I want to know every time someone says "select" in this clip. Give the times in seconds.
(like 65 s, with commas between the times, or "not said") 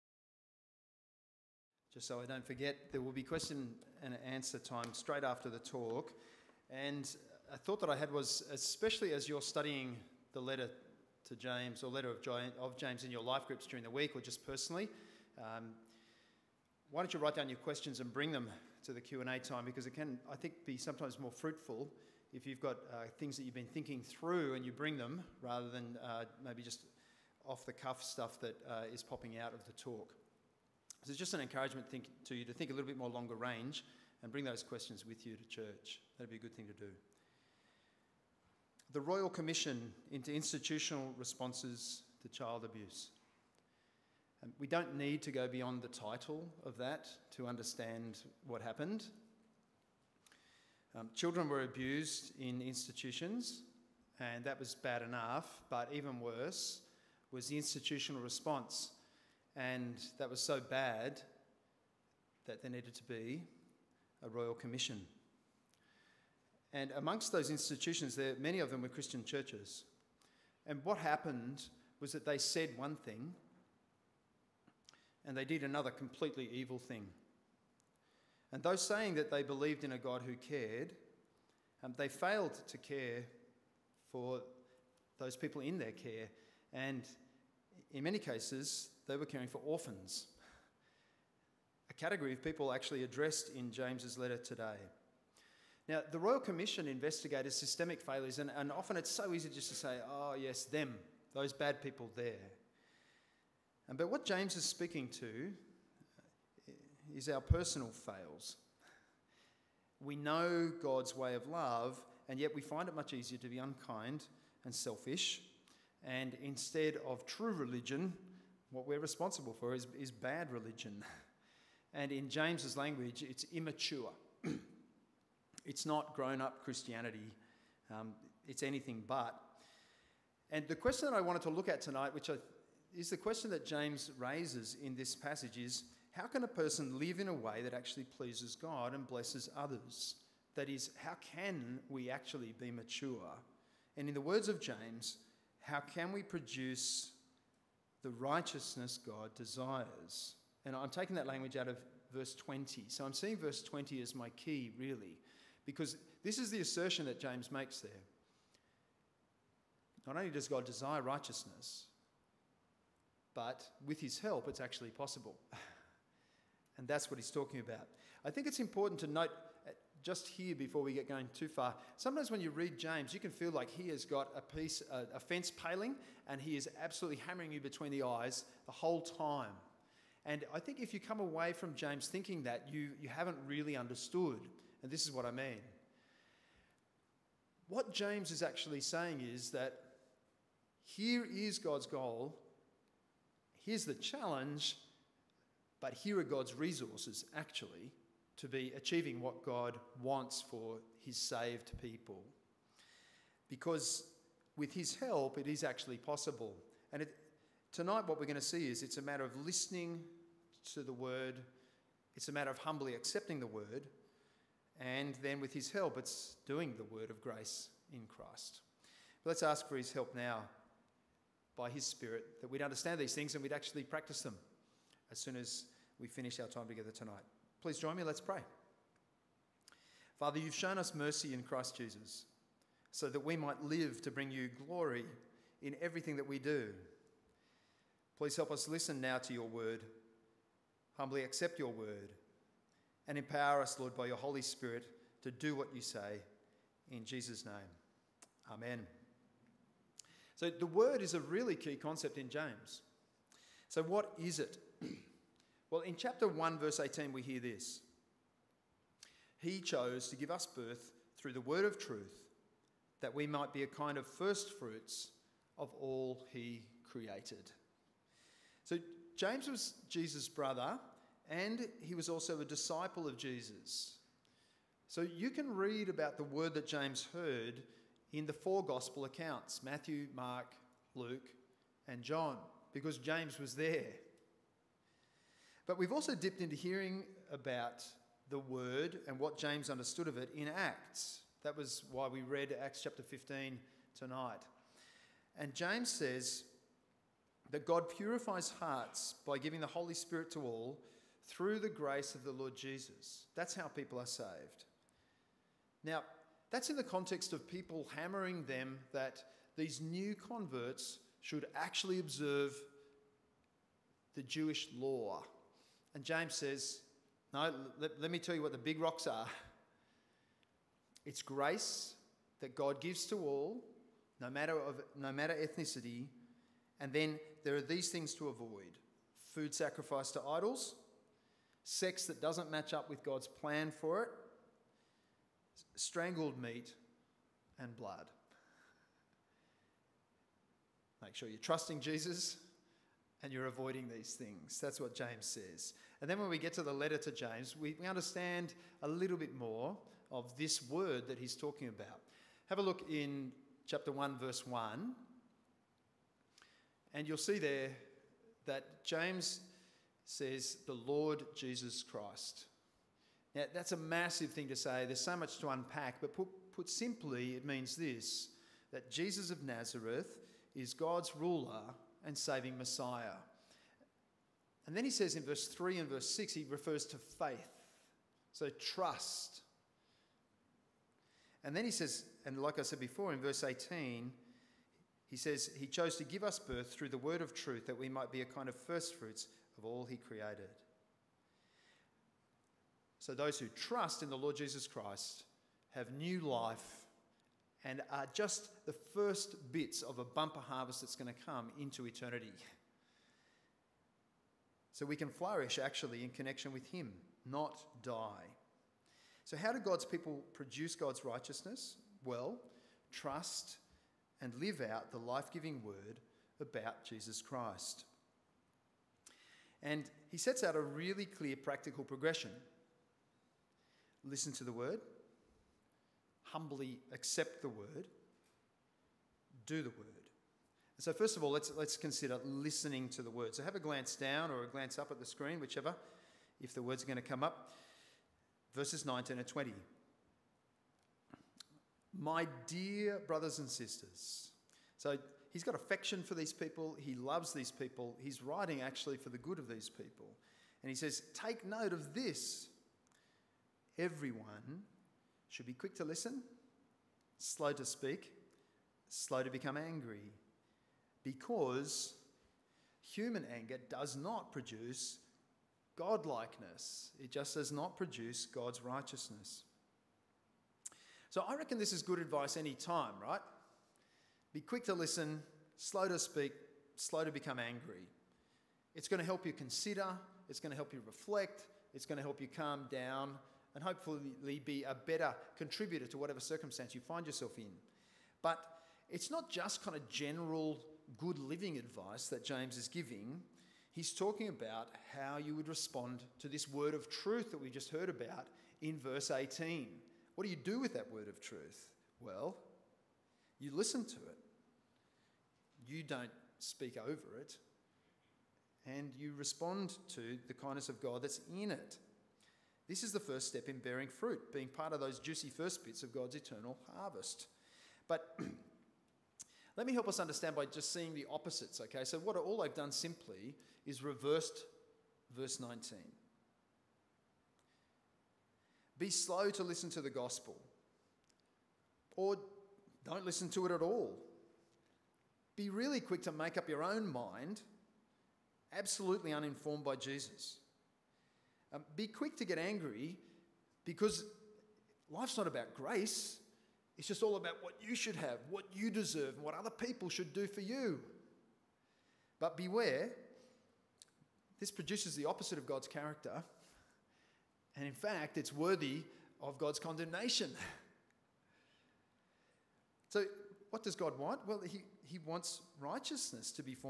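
not said.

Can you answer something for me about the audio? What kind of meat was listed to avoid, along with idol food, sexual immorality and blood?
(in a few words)
strangled meat.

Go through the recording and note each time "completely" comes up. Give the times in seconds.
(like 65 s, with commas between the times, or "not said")
75 s.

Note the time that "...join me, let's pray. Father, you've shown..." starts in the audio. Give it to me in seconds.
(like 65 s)
227 s.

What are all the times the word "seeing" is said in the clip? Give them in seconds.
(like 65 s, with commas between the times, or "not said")
153 s, 520 s.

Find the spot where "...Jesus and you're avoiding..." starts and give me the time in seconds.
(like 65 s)
341 s.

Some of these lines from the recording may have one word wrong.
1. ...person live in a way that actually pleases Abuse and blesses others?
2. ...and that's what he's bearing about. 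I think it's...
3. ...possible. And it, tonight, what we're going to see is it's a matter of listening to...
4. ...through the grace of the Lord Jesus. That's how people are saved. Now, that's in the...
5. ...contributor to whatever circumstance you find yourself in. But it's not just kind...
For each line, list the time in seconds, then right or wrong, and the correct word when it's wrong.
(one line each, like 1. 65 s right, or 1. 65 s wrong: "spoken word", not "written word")
1. 136 s wrong: "God", not "Abuse"
2. 166 s wrong: "talking", not "bearing"
3. 205 s right
4. 301 s right
5. 485 s right.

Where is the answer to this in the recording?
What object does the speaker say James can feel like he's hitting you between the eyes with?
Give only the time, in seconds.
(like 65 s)
175 s.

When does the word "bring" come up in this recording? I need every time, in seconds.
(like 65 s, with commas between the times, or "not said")
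18 s, 24 s, 34 s, 234 s.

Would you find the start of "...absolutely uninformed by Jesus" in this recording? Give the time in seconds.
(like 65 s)
538 s.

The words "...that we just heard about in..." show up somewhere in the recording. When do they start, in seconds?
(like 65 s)
497 s.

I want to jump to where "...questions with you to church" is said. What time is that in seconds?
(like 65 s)
34 s.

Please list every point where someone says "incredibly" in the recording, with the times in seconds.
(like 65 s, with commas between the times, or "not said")
not said.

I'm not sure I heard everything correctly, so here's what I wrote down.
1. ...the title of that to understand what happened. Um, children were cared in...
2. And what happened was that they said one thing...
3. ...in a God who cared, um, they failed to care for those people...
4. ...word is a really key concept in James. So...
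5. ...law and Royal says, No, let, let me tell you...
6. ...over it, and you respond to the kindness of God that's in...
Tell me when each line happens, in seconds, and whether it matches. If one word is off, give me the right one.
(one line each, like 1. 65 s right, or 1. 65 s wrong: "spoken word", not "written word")
1. 45 s wrong: "abused", not "cared"
2. 70 s right
3. 79 s right
4. 250 s right
5. 314 s wrong: "James", not "Royal"
6. 506 s right.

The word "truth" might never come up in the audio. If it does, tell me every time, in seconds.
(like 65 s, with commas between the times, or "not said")
261 s, 387 s, 496 s, 501 s.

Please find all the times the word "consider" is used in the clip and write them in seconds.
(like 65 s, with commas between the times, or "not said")
431 s, 479 s.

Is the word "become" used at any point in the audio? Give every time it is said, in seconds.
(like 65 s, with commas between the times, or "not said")
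459 s, 477 s.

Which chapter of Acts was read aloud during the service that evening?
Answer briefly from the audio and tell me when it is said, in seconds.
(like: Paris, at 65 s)
Acts chapter 15, at 292 s.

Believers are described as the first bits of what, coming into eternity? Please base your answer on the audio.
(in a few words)
a bumper harvest.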